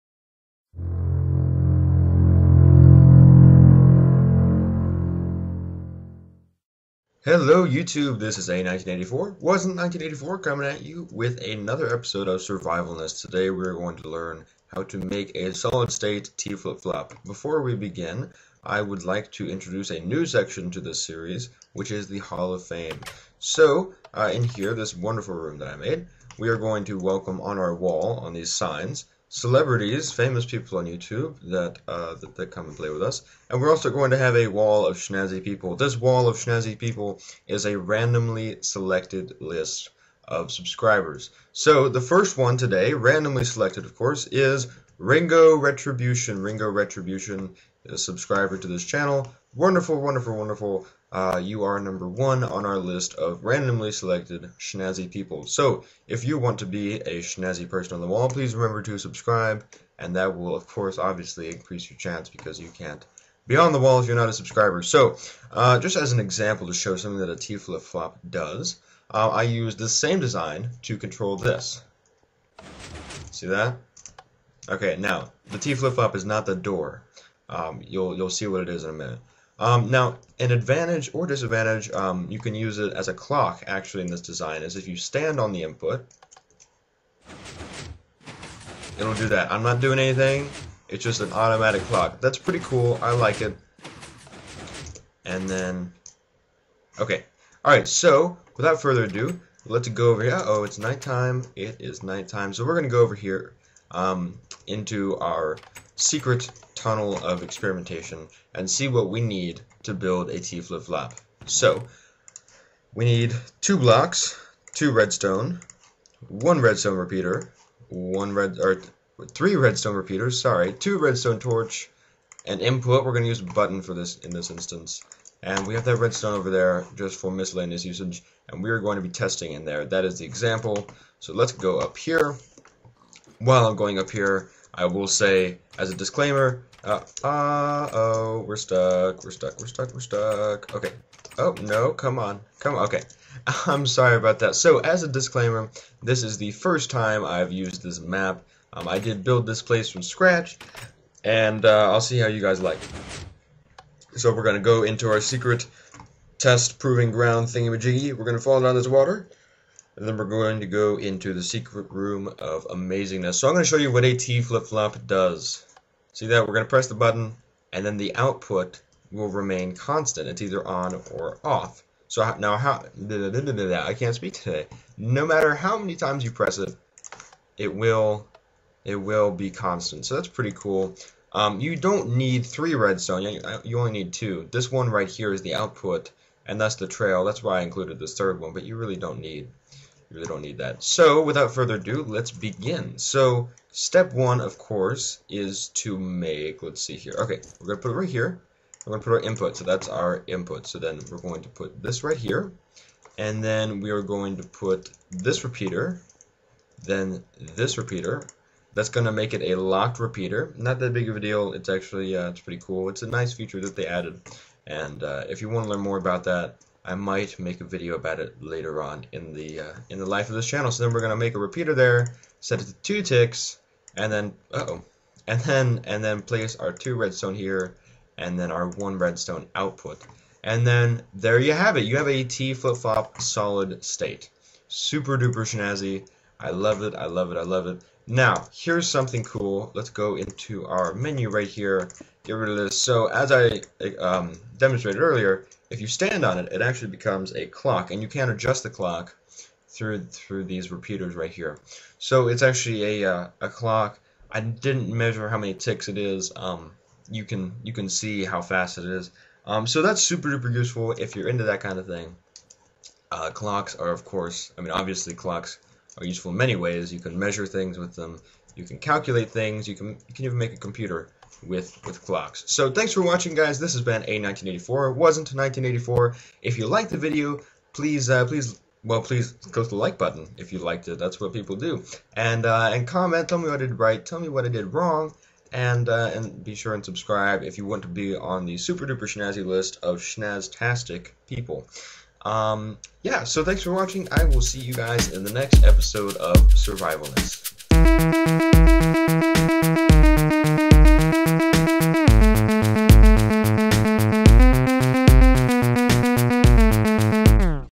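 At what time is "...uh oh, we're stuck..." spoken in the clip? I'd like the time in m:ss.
2:17.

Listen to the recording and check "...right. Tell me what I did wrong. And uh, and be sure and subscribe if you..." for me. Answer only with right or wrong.
right.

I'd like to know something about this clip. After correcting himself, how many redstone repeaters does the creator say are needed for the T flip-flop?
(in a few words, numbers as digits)
3.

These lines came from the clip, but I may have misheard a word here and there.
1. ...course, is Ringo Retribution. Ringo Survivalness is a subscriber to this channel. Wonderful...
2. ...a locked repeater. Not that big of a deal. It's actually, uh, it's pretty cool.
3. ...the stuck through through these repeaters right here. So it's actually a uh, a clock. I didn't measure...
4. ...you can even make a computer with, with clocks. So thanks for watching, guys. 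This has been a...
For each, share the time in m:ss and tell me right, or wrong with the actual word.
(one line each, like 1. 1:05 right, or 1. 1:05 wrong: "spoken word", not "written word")
1. 0:43 wrong: "Retribution", not "Survivalness"
2. 3:29 right
3. 4:08 wrong: "clock", not "stuck"
4. 4:30 right.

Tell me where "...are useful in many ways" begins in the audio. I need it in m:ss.
4:25.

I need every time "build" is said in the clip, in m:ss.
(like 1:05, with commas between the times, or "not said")
1:49, 2:29.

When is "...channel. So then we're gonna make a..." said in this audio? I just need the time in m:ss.
3:40.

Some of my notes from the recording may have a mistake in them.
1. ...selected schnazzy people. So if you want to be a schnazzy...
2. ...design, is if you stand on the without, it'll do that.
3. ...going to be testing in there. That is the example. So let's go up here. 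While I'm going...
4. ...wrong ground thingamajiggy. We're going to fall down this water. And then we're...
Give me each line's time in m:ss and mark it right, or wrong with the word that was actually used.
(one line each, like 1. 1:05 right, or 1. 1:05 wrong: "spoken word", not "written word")
1. 0:53 right
2. 1:24 wrong: "input", not "without"
3. 2:08 right
4. 2:36 wrong: "proving", not "wrong".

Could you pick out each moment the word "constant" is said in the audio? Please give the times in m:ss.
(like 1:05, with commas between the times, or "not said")
2:49, 2:59.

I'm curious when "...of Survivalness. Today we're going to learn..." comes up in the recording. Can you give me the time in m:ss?
0:12.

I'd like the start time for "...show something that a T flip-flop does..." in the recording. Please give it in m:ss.
1:06.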